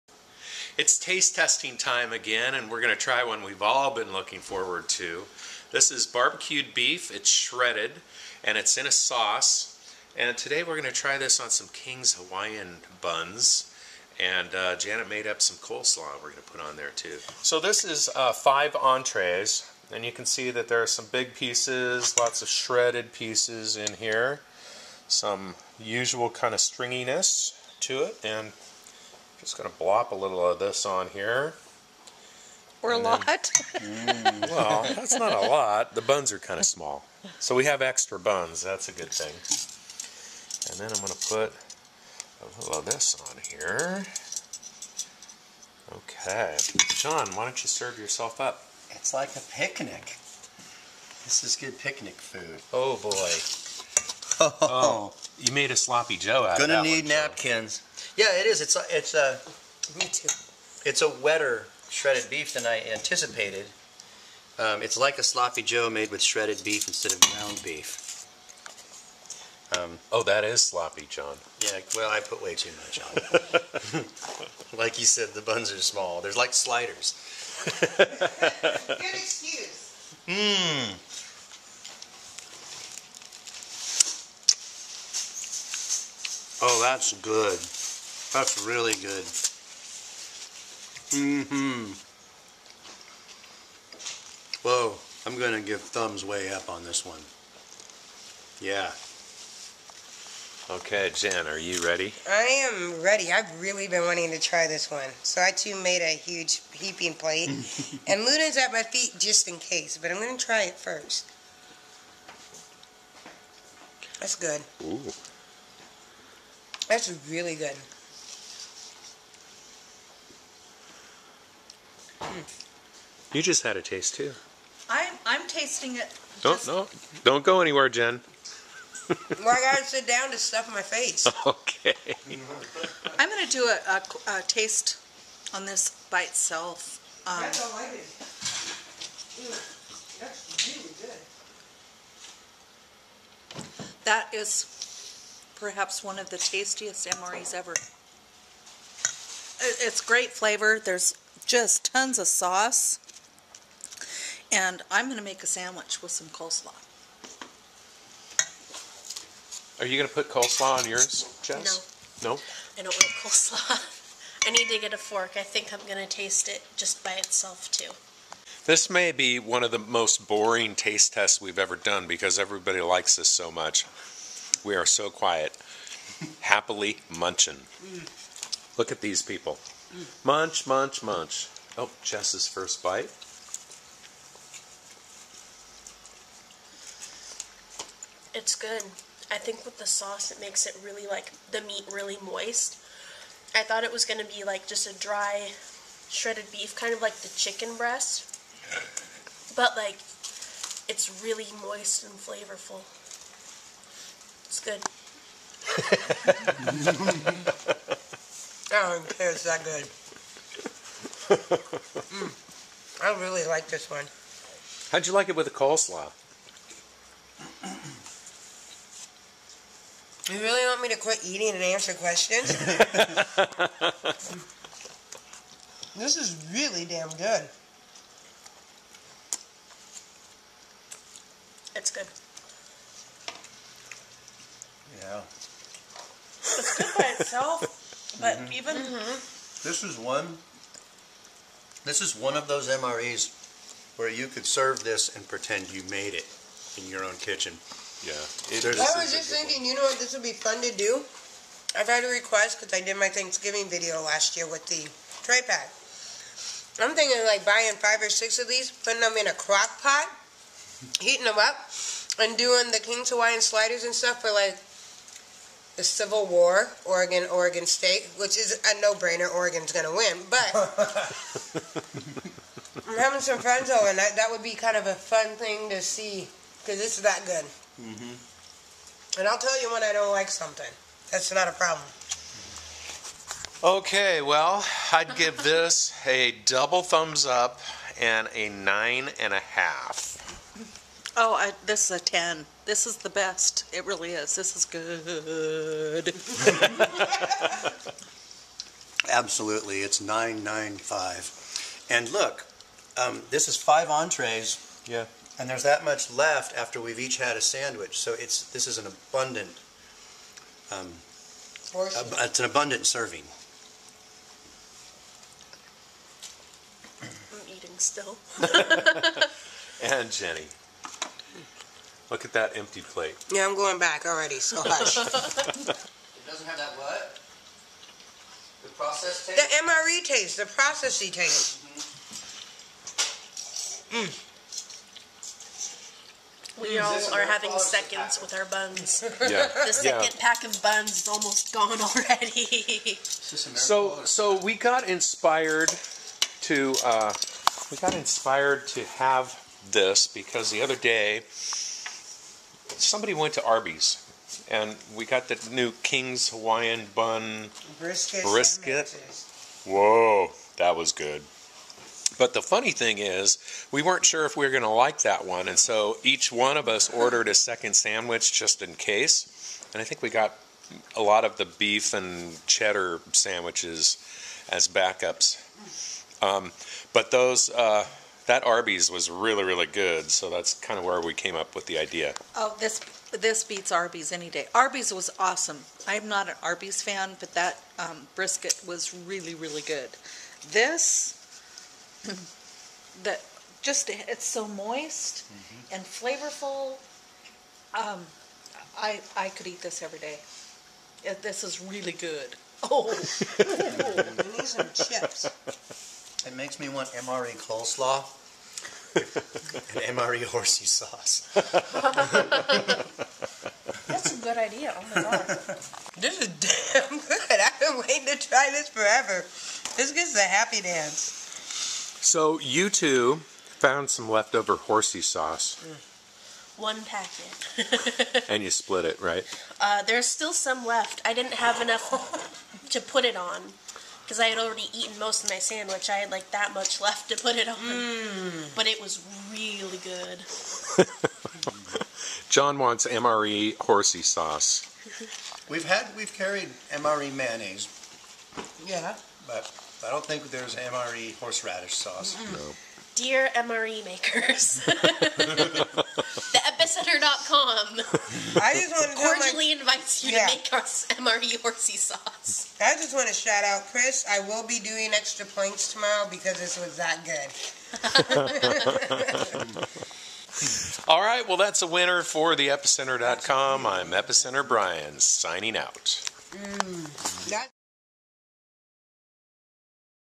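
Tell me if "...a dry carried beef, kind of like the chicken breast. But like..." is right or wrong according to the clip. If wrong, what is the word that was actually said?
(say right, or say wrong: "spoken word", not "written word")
wrong: "shredded", not "carried".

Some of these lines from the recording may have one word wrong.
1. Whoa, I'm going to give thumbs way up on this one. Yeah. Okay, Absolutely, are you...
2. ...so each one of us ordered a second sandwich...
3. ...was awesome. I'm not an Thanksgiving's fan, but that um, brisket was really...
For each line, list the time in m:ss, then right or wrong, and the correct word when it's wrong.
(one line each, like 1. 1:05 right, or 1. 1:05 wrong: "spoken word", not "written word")
1. 1:34 wrong: "Jen", not "Absolutely"
2. 6:05 right
3. 6:24 wrong: "Arby", not "Thanksgiving".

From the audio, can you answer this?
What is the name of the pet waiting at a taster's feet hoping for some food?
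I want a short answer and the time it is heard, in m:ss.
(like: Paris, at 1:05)
Luna, at 1:48.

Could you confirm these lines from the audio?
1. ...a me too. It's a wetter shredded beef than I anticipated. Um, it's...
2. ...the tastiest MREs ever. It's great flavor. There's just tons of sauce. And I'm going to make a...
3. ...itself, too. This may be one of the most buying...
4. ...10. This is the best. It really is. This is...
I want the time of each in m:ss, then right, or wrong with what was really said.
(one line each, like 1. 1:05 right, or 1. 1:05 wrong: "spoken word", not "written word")
1. 0:59 right
2. 2:26 right
3. 2:47 wrong: "boring", not "buying"
4. 4:52 right.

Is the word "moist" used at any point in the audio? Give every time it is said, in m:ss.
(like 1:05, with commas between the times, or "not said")
3:12, 3:21, 6:34.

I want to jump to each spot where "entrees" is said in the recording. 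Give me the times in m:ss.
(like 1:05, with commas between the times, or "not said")
0:18, 5:03.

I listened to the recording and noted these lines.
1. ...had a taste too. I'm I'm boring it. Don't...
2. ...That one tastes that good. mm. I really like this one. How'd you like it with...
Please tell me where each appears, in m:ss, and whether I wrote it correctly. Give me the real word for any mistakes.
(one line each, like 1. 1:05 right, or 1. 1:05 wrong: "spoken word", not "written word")
1. 2:03 wrong: "tasting", not "boring"
2. 3:28 right.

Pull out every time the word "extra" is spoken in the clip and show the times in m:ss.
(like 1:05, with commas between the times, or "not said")
0:37, 7:44.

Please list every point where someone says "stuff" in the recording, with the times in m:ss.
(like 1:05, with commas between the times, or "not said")
2:10, 4:23.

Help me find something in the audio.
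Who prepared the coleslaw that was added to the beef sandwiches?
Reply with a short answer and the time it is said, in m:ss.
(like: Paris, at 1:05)
Janet, at 0:14.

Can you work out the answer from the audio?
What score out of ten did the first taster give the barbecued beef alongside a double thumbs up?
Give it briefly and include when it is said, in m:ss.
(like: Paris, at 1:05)
9.5, at 4:48.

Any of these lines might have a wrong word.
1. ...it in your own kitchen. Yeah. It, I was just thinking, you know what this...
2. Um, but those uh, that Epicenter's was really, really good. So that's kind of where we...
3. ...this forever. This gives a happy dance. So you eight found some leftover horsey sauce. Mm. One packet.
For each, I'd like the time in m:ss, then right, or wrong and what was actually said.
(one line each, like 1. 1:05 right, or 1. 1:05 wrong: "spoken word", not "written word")
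1. 4:06 right
2. 6:16 wrong: "Arby", not "Epicenter"
3. 6:58 wrong: "two", not "eight".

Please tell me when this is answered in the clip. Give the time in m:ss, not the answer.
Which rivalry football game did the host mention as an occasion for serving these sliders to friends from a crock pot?
4:25.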